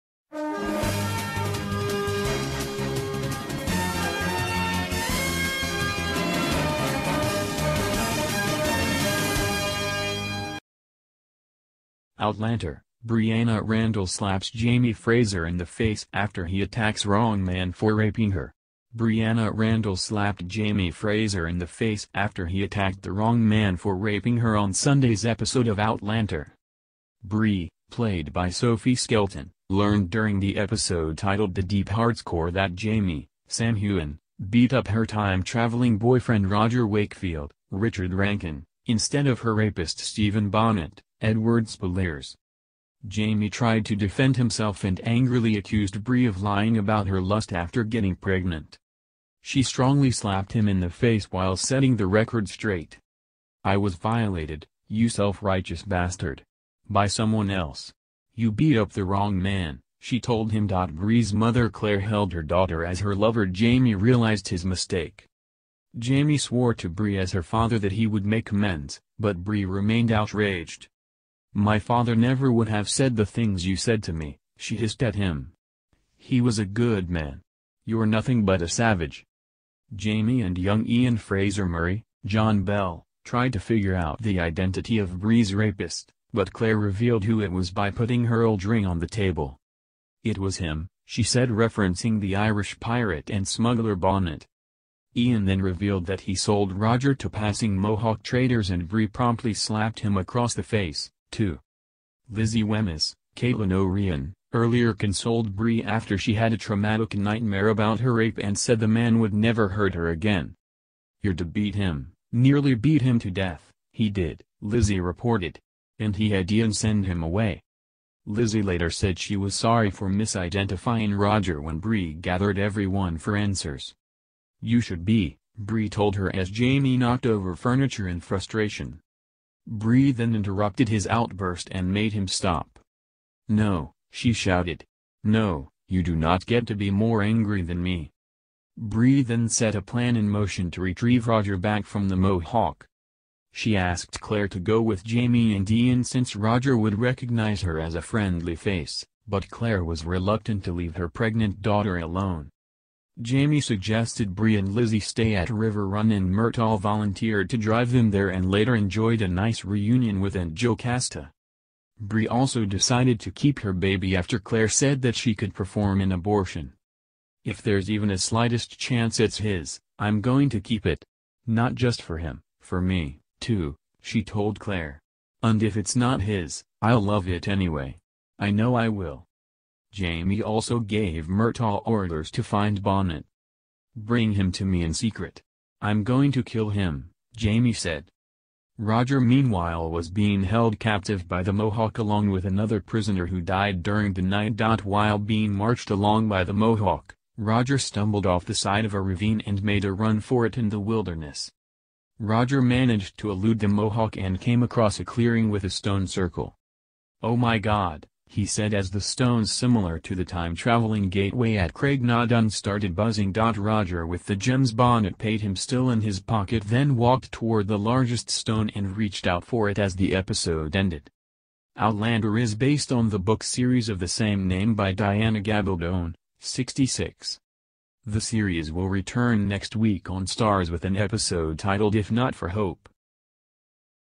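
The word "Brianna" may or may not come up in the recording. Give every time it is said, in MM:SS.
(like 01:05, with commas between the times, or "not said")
00:13, 00:18.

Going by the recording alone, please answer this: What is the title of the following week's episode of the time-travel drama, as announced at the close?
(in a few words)
If Not for Hope.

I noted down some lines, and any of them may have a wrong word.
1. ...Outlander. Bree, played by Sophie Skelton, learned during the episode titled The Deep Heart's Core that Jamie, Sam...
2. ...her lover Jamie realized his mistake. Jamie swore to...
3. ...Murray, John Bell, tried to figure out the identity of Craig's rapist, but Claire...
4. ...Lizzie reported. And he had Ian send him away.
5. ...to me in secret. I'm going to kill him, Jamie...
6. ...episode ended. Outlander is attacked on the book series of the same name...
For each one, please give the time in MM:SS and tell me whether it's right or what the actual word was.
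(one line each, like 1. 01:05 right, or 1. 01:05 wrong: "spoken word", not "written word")
1. 00:25 right
2. 01:03 right
3. 01:21 wrong: "Bree", not "Craig"
4. 01:54 right
5. 03:04 right
6. 03:40 wrong: "based", not "attacked".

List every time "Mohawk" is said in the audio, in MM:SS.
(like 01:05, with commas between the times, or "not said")
01:37, 02:22, 03:11, 03:16, 03:23.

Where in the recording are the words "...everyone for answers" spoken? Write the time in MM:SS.
02:02.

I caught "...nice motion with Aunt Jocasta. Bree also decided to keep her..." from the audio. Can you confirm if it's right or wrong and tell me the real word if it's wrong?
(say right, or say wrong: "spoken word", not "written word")
wrong: "reunion", not "motion".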